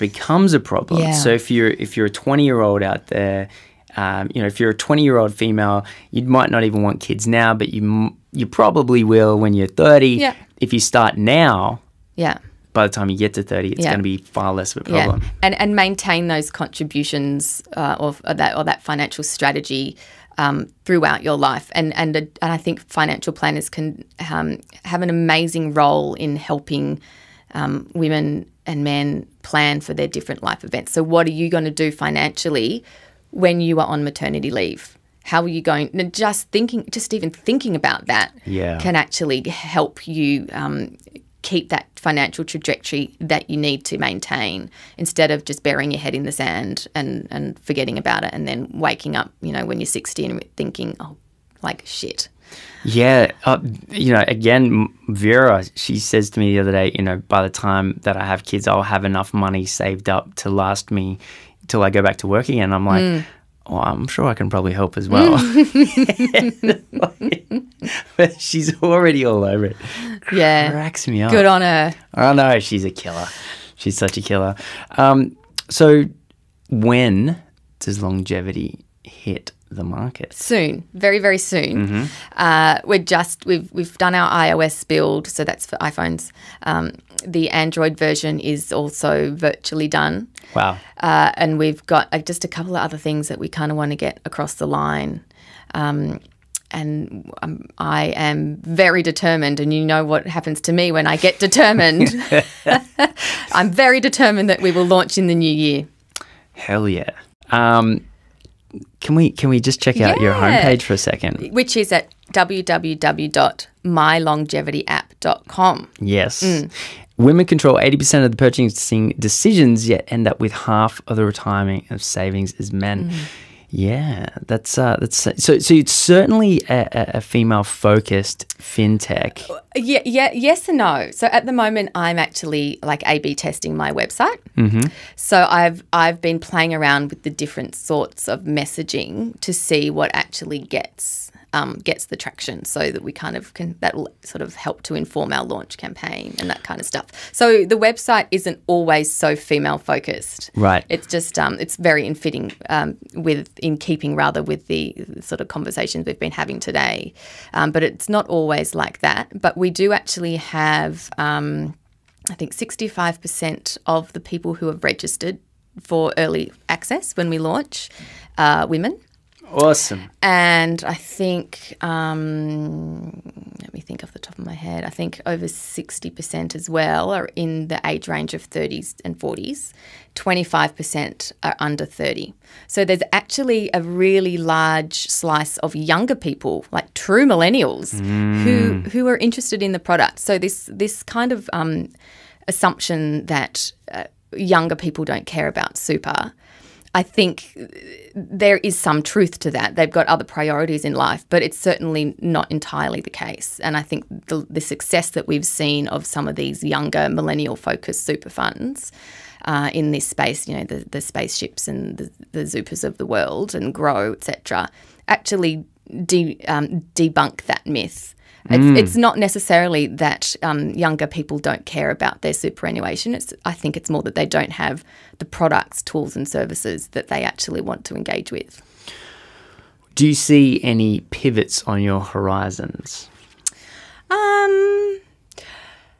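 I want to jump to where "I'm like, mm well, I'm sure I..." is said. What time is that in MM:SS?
01:02.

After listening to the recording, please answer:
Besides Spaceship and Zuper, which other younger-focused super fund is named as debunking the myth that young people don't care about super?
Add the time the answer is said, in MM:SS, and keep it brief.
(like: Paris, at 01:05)
Grow, at 03:33.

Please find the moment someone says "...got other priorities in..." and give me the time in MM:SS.
03:19.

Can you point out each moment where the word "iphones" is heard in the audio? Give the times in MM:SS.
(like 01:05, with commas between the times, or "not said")
01:25.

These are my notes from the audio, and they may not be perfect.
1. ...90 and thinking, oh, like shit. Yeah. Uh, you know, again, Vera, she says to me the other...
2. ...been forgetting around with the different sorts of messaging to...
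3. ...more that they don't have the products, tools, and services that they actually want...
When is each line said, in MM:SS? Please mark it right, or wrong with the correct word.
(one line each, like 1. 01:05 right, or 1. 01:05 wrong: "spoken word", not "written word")
1. 00:49 wrong: "60", not "90"
2. 02:16 wrong: "playing", not "forgetting"
3. 03:43 right.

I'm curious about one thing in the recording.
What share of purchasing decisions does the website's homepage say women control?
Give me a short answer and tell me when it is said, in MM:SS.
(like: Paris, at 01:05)
80%, at 01:57.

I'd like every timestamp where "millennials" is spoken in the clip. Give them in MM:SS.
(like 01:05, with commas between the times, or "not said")
03:07, 03:27.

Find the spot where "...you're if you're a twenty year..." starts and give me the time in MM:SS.
00:01.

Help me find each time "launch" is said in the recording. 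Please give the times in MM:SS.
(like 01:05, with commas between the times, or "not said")
01:44, 02:25, 02:47.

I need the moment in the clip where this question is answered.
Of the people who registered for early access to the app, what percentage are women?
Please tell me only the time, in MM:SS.
02:42.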